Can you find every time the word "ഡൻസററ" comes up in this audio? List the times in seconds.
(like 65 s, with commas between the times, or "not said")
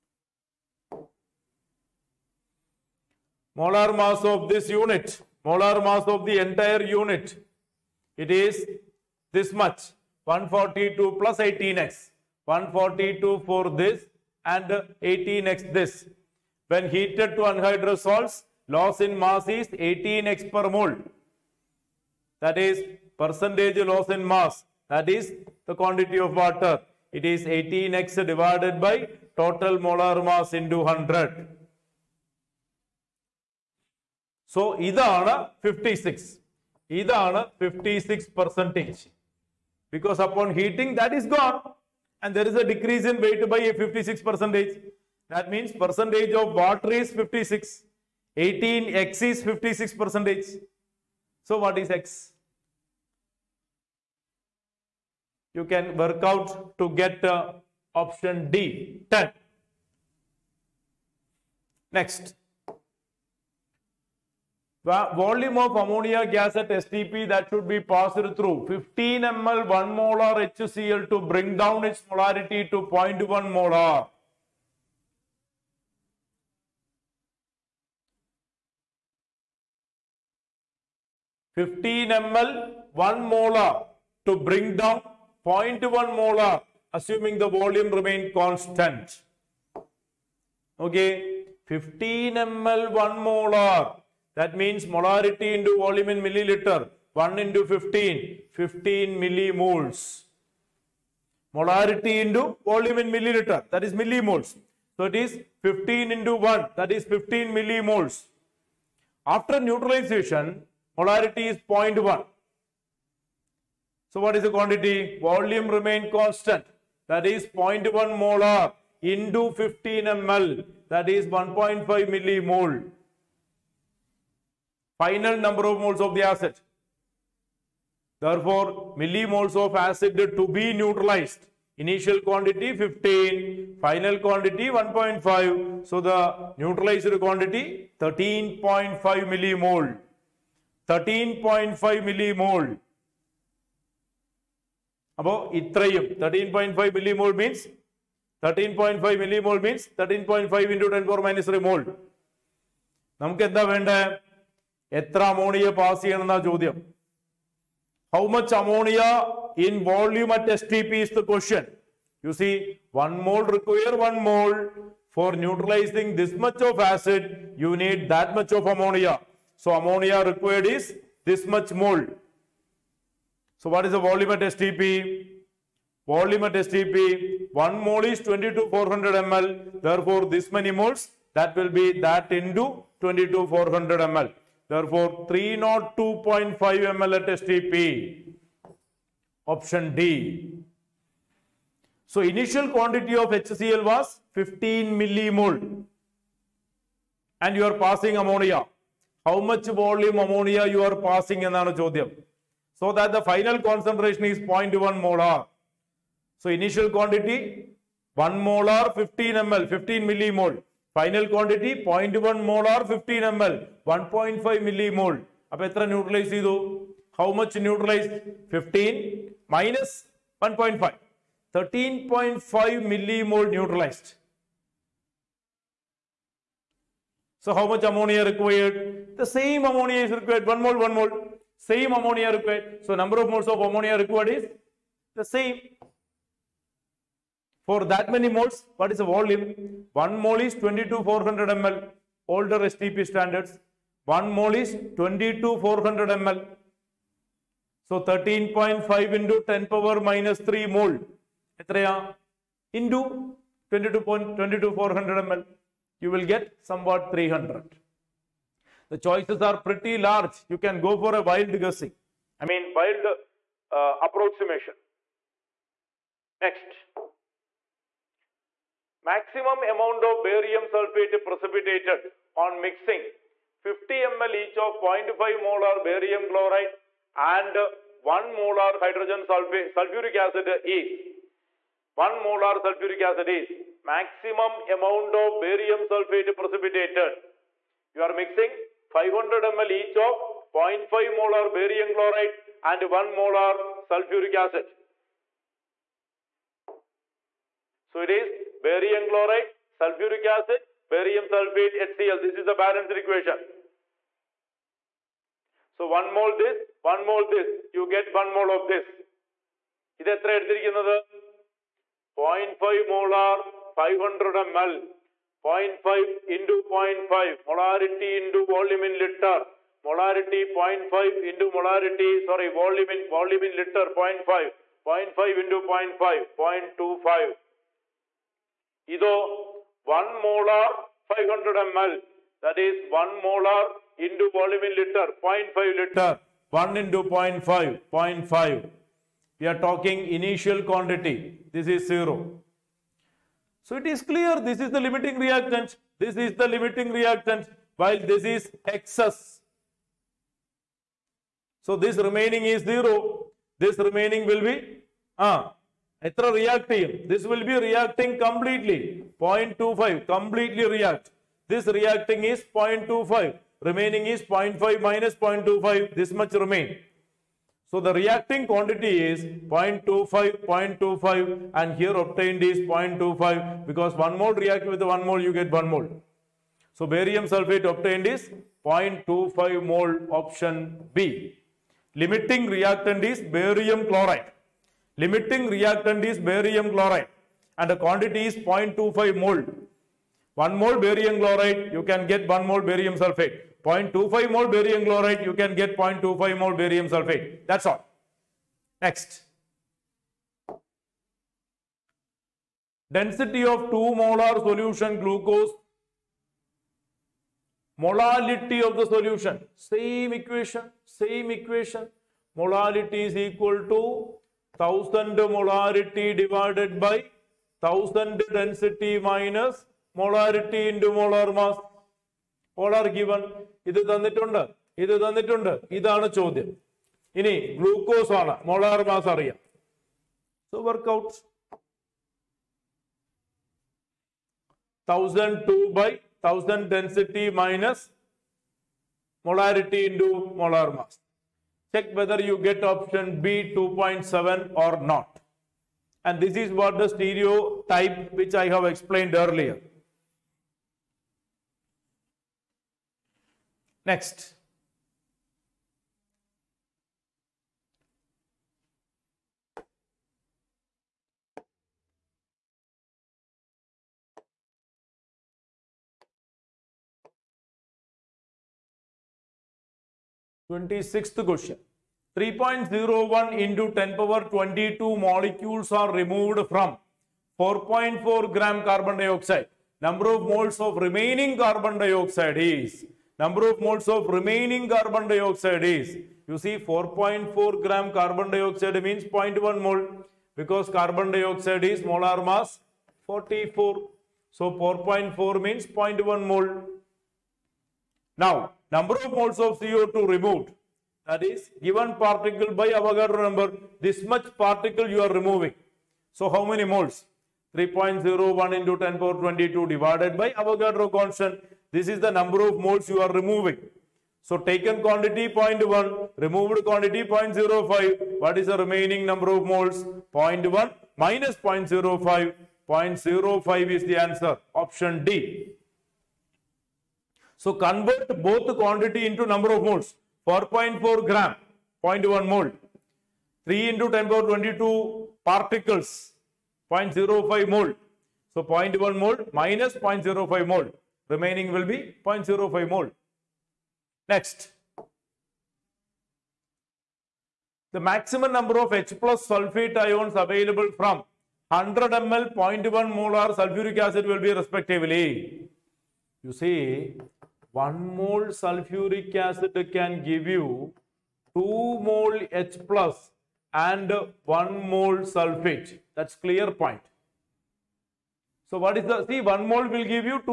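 418 s, 436 s.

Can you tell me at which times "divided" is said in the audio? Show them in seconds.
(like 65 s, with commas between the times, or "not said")
28 s, 509 s.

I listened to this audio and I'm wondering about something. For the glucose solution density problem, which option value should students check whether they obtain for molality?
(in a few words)
2.7.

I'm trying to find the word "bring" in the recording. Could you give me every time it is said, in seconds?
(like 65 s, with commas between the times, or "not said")
71 s, 84 s.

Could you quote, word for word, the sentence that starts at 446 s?
And this is what the stereo type which I have explained earlier.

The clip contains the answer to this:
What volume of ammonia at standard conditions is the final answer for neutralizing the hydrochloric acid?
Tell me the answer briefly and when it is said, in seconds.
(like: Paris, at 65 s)
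302.5 ml, at 185 s.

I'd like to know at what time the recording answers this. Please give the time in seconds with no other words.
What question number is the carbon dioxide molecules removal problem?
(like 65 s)
470 s.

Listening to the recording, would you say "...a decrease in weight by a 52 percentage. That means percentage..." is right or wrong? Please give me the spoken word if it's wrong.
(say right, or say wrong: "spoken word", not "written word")
wrong: "56", not "52".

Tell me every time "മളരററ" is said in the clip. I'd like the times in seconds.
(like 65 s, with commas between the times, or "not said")
415 s, 419 s, 439 s.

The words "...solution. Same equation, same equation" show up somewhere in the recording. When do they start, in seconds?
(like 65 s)
408 s.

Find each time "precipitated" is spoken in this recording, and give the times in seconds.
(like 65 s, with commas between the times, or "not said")
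271 s, 286 s.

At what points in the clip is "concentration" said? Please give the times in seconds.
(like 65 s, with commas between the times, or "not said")
203 s.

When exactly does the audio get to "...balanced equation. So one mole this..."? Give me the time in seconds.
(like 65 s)
302 s.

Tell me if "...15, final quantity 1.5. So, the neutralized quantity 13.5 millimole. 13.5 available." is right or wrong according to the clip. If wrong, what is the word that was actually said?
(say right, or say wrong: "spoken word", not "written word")
wrong: "millimole", not "available".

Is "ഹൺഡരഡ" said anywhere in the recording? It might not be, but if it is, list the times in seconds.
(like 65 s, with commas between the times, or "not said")
178 s, 183 s.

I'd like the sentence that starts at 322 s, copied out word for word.
Sorry, volume volume in liter 0.5.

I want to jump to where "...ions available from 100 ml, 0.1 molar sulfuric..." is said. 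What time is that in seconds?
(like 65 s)
549 s.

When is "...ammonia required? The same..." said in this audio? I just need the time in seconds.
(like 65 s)
227 s.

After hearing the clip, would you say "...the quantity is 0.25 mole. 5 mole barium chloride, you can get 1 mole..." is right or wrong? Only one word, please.
wrong.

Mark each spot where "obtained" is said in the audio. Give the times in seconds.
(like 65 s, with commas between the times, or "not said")
372 s, 377 s.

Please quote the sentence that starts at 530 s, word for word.
4.4 gram, 0.1 mole, 3 into 10 power 22 particles, 0.05 mole.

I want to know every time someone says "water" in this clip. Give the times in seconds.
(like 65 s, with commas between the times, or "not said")
26 s, 46 s.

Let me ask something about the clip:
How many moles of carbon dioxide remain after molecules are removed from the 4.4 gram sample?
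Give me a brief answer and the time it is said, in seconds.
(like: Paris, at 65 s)
0.05, at 522 s.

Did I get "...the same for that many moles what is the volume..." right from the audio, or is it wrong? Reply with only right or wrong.
right.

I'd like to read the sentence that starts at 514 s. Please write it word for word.
So taken quantity 0.1, removed quantity 0.05.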